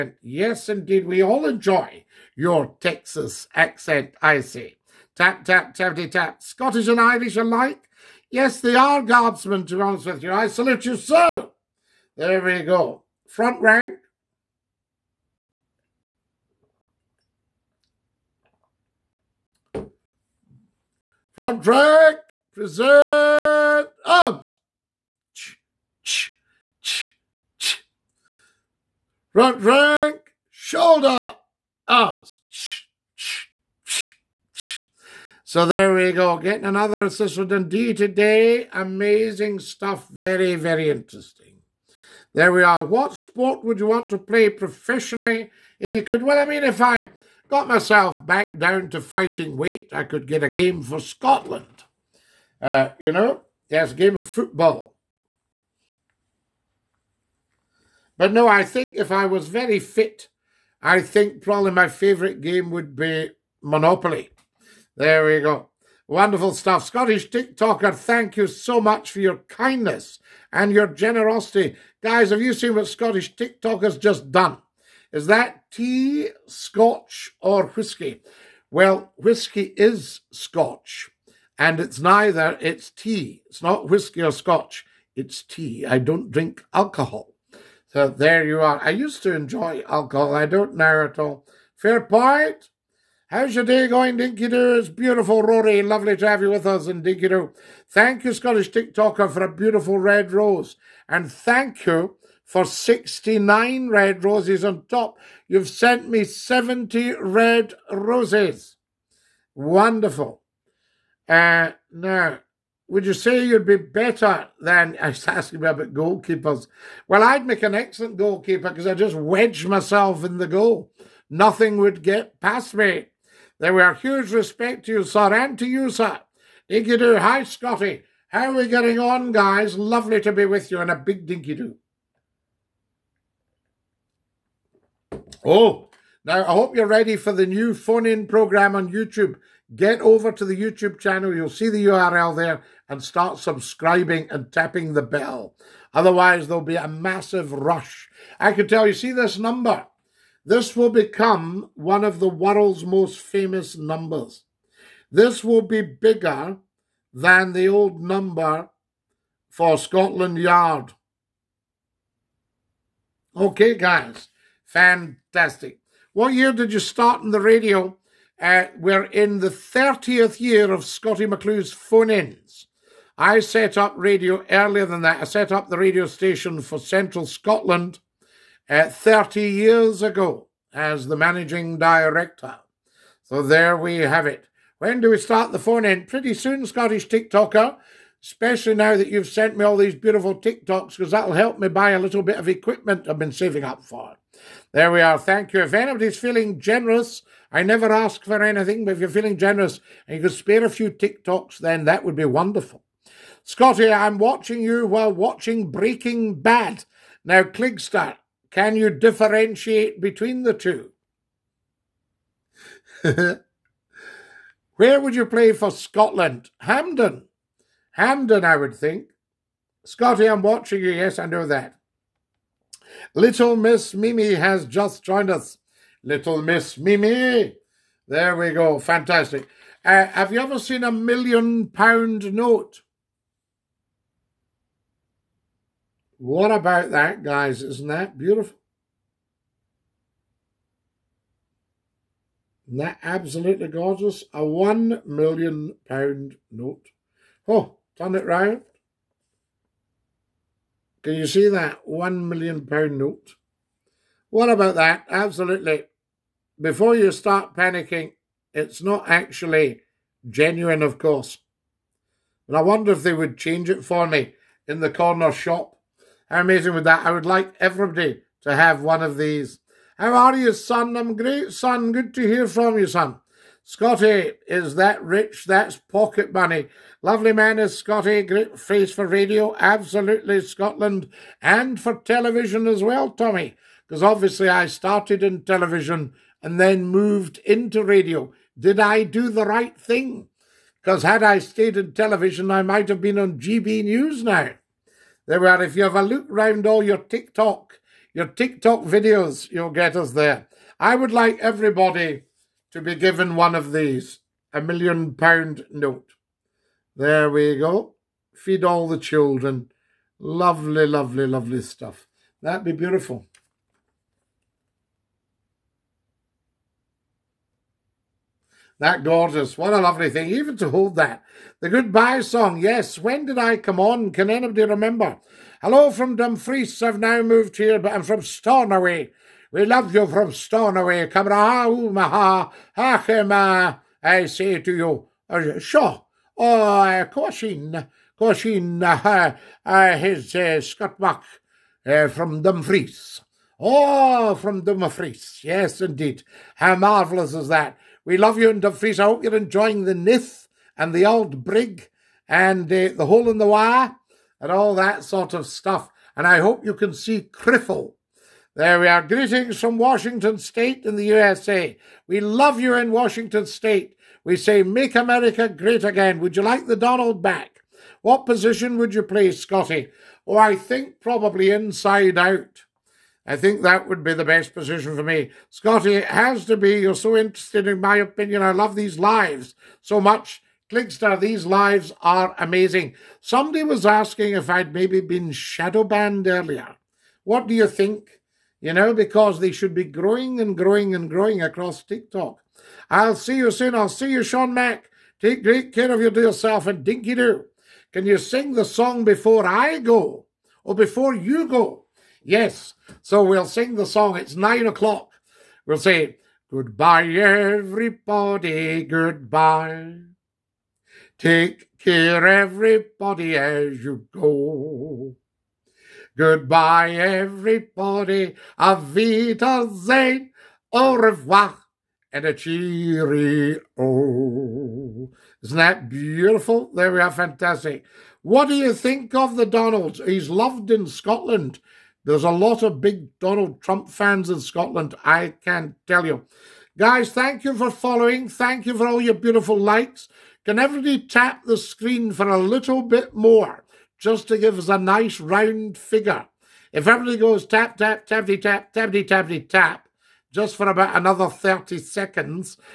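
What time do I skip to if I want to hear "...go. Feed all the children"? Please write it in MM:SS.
05:07.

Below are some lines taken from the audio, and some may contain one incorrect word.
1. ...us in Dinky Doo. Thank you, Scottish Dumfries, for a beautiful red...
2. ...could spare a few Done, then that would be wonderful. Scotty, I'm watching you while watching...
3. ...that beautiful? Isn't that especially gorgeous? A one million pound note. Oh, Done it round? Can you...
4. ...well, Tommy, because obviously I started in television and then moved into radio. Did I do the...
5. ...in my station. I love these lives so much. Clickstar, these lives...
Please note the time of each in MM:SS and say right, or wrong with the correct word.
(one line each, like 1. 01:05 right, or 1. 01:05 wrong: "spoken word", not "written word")
1. 01:36 wrong: "TikToker", not "Dumfries"
2. 03:20 wrong: "TikToks", not "Done"
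3. 03:57 wrong: "absolutely", not "especially"
4. 04:42 right
5. 06:17 wrong: "opinion", not "station".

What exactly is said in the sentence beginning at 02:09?
Lovely to be with you and a big dinky do.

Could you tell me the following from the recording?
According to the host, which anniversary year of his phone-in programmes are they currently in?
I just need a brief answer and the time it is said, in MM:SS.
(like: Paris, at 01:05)
30th year, at 02:49.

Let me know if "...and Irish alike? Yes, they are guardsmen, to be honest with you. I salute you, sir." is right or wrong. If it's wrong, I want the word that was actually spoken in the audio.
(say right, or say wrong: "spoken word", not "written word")
right.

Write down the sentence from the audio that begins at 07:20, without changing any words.
Can everybody tap the screen for a little bit more?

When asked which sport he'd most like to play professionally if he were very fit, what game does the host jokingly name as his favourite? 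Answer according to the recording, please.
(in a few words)
Monopoly.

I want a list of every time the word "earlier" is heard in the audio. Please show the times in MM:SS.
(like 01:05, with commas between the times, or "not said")
02:54, 06:26.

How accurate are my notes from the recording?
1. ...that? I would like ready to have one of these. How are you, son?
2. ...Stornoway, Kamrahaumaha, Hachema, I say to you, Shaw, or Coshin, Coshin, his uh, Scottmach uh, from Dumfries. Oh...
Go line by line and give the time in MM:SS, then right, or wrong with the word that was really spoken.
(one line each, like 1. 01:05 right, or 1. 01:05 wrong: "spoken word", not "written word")
1. 04:26 wrong: "everybody", not "ready"
2. 05:30 right.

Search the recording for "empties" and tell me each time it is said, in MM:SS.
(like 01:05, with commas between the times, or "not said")
not said.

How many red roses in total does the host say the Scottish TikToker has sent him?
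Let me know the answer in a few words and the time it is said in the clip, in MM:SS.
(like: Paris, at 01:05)
70, at 01:46.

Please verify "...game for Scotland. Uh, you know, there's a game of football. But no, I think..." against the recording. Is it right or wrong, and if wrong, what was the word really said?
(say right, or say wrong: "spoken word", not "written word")
right.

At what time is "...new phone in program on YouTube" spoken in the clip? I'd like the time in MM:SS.
02:17.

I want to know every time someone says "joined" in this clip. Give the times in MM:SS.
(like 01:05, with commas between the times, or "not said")
03:45.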